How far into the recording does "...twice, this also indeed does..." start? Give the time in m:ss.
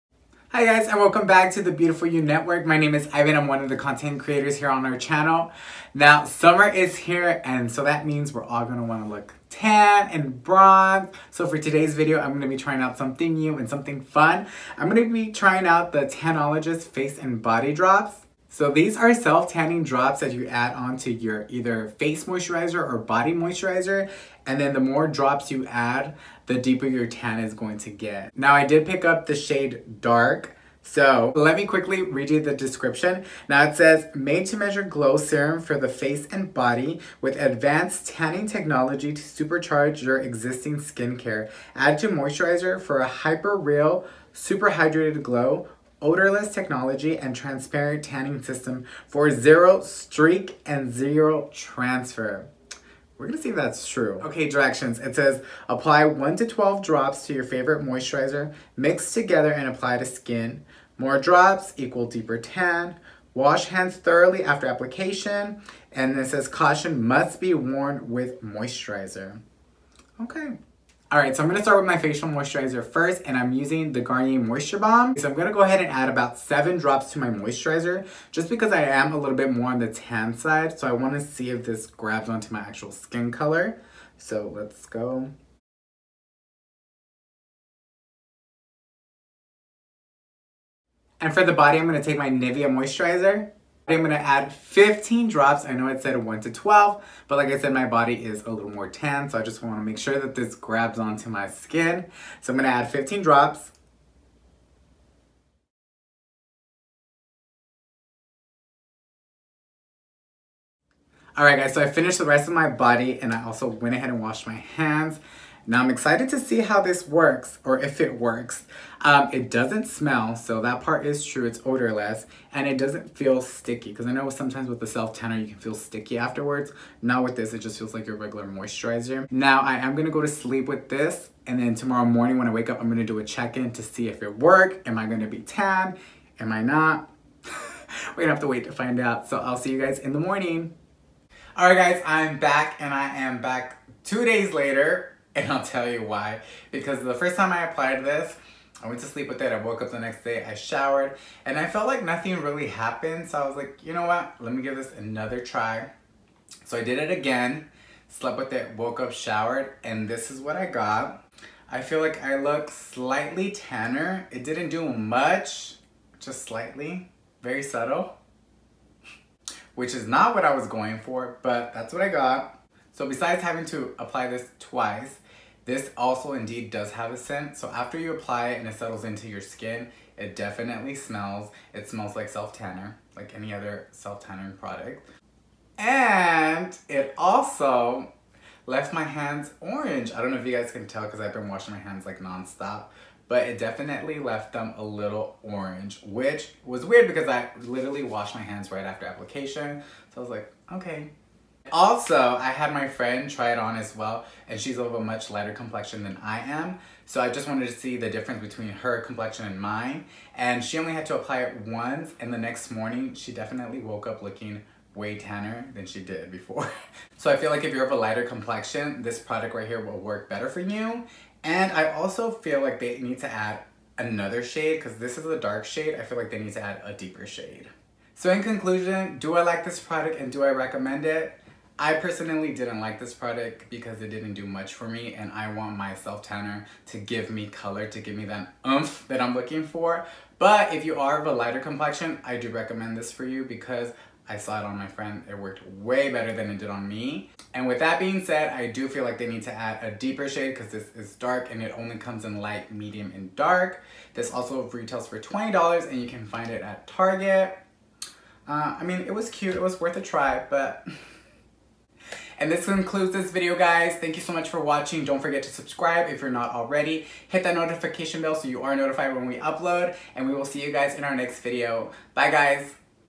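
2:54.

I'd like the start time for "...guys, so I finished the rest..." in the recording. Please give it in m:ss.
1:51.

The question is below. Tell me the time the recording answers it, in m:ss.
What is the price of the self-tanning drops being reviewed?
4:15.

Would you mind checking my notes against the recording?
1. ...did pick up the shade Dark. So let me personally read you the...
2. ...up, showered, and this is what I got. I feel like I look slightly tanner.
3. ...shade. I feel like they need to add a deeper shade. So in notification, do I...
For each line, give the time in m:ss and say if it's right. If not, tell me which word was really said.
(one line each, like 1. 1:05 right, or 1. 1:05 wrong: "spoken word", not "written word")
1. 0:28 wrong: "quickly", not "personally"
2. 2:38 right
3. 3:45 wrong: "conclusion", not "notification".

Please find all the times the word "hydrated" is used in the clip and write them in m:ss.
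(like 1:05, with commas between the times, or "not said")
0:44.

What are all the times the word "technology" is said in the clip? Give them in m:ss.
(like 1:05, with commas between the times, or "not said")
0:38, 0:46.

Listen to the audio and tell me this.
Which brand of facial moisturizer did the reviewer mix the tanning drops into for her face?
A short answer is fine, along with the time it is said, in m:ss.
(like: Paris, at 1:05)
Garnier Moisture Balm, at 1:13.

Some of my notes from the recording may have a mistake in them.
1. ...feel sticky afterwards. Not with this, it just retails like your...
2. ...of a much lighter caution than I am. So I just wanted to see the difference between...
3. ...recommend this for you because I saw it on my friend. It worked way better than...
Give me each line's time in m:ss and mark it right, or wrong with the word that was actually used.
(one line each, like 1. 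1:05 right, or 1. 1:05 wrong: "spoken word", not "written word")
1. 2:05 wrong: "feels", not "retails"
2. 3:24 wrong: "complexion", not "caution"
3. 4:02 right.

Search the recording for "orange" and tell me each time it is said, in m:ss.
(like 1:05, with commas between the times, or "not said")
3:09, 3:15.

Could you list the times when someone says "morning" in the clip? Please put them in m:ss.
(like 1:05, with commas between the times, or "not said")
2:12, 2:20, 3:32.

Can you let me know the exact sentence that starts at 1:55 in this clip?
Now I'm excited to see how this works or if it works.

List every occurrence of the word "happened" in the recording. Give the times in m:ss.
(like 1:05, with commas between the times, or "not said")
2:32.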